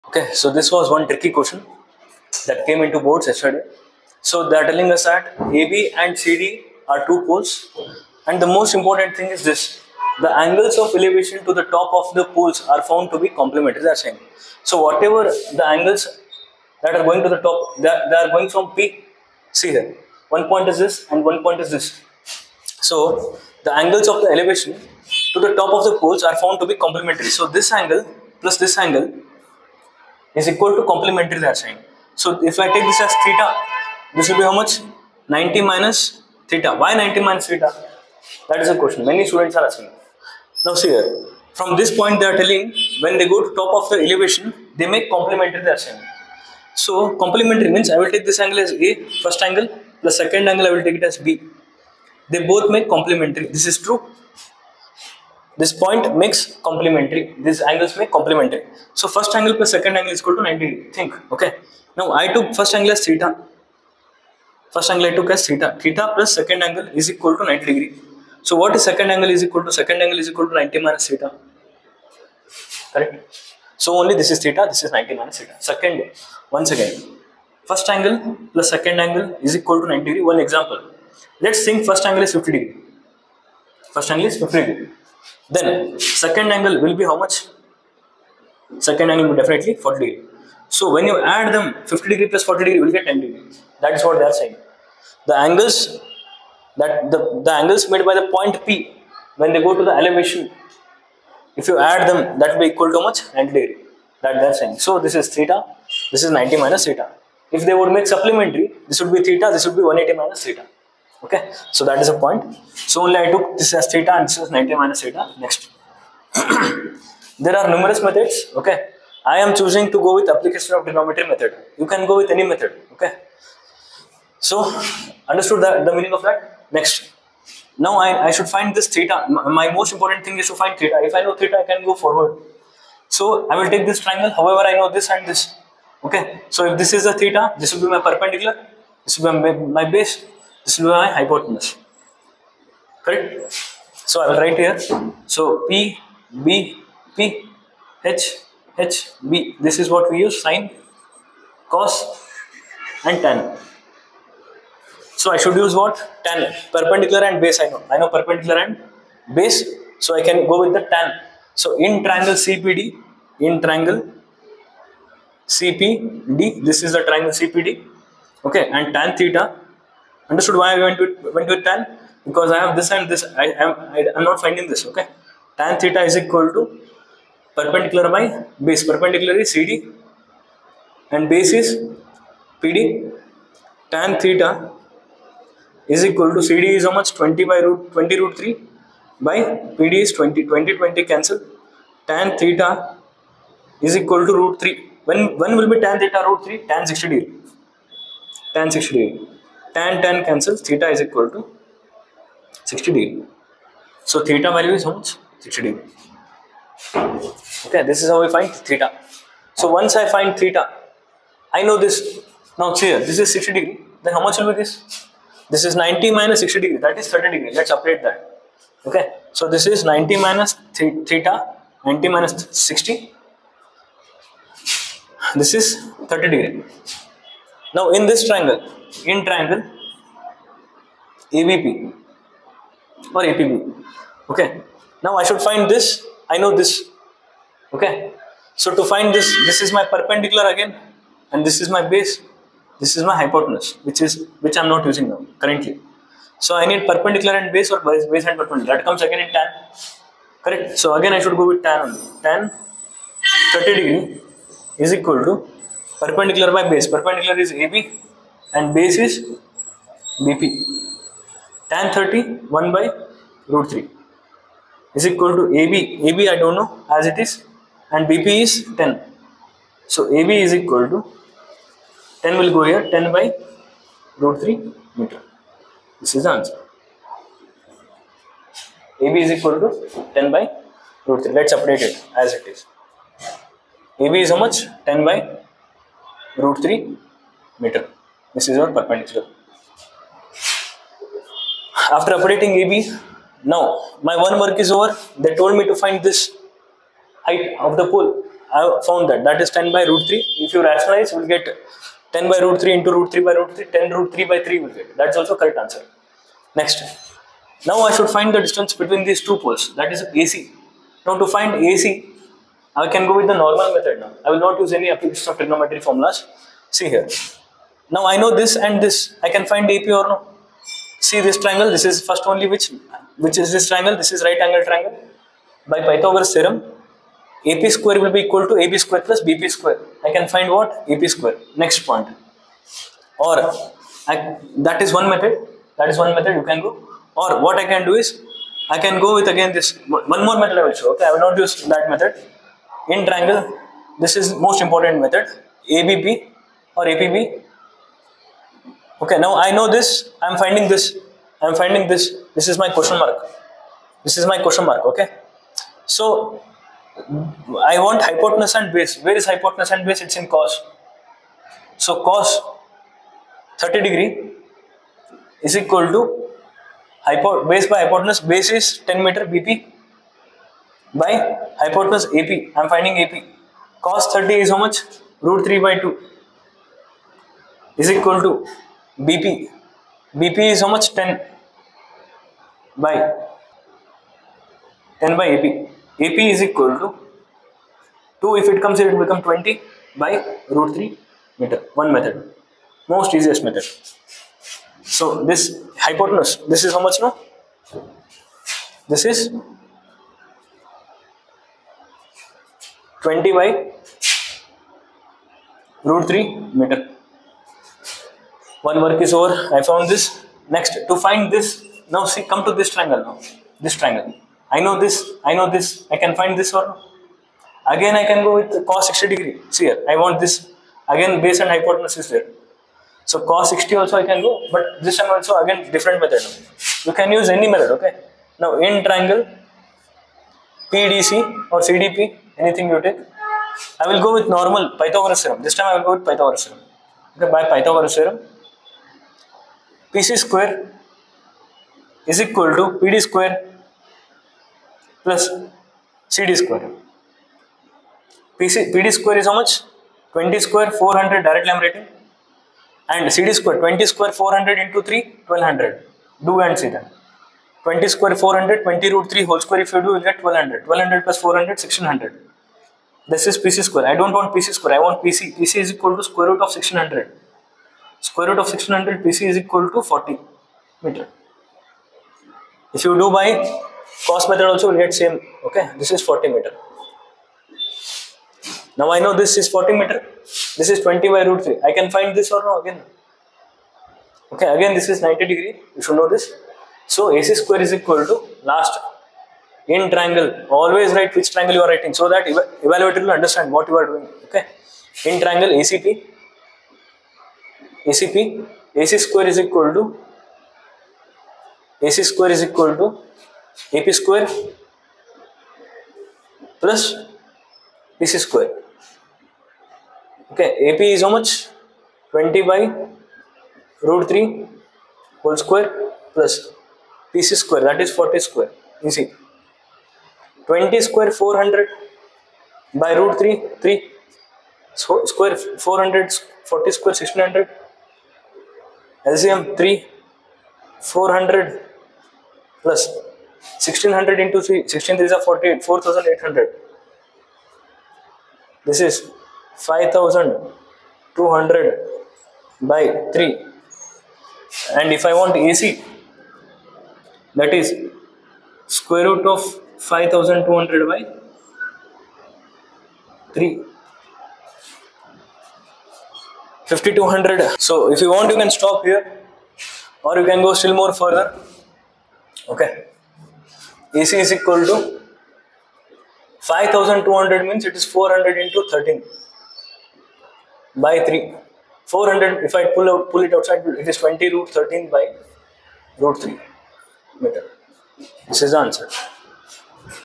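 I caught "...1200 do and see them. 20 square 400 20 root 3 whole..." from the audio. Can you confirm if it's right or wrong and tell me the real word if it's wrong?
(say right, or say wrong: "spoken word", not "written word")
right.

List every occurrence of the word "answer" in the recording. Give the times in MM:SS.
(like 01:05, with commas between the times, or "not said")
04:36, 05:05, 09:38.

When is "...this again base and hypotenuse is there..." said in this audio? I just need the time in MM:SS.
07:00.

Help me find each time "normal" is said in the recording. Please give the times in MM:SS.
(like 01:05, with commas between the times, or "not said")
05:13, 07:14.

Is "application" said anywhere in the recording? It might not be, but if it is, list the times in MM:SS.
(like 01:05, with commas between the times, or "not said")
02:00, 05:14.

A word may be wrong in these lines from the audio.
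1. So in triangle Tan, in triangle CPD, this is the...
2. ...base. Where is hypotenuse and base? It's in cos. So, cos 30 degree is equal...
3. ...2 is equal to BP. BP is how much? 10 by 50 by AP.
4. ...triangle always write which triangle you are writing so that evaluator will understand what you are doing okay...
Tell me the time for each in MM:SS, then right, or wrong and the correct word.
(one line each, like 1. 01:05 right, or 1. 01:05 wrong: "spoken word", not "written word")
1. 02:41 wrong: "CPD", not "Tan"
2. 05:58 right
3. 06:15 wrong: "10", not "50"
4. 08:09 right.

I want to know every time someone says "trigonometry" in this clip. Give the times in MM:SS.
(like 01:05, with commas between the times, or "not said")
02:00, 05:15.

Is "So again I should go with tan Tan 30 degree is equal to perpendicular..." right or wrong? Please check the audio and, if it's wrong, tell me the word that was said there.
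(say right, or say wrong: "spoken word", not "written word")
right.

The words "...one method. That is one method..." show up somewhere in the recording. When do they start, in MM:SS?
05:34.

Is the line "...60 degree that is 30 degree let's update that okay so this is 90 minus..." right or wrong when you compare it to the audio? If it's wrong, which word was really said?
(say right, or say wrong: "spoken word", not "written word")
right.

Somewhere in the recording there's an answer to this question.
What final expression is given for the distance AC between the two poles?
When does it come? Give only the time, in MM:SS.
09:33.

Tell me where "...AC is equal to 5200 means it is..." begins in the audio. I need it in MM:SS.
09:24.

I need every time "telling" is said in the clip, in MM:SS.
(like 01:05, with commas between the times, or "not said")
00:04, 00:42.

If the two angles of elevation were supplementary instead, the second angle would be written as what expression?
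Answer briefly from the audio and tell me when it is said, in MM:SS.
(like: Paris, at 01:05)
180 minus theta, at 01:49.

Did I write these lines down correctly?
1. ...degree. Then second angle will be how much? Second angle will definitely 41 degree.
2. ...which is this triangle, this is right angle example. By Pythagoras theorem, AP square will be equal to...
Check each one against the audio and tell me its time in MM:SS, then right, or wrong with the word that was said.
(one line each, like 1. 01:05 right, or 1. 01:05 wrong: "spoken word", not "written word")
1. 01:24 wrong: "40", not "41"
2. 05:23 wrong: "triangle", not "example".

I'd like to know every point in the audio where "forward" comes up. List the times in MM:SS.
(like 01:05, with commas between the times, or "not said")
02:11.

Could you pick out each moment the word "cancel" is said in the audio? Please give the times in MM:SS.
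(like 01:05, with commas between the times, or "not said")
03:11, 03:20.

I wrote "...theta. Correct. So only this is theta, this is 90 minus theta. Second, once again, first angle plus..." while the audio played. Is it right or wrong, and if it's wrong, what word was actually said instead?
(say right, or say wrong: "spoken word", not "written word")
right.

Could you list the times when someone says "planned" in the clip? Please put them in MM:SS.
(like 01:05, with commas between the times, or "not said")
not said.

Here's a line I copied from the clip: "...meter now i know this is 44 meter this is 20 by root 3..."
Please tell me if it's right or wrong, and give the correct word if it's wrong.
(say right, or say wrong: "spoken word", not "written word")
wrong: "40", not "44".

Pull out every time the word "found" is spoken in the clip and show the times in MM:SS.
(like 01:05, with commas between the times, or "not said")
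00:12, 00:26, 04:58, 06:49.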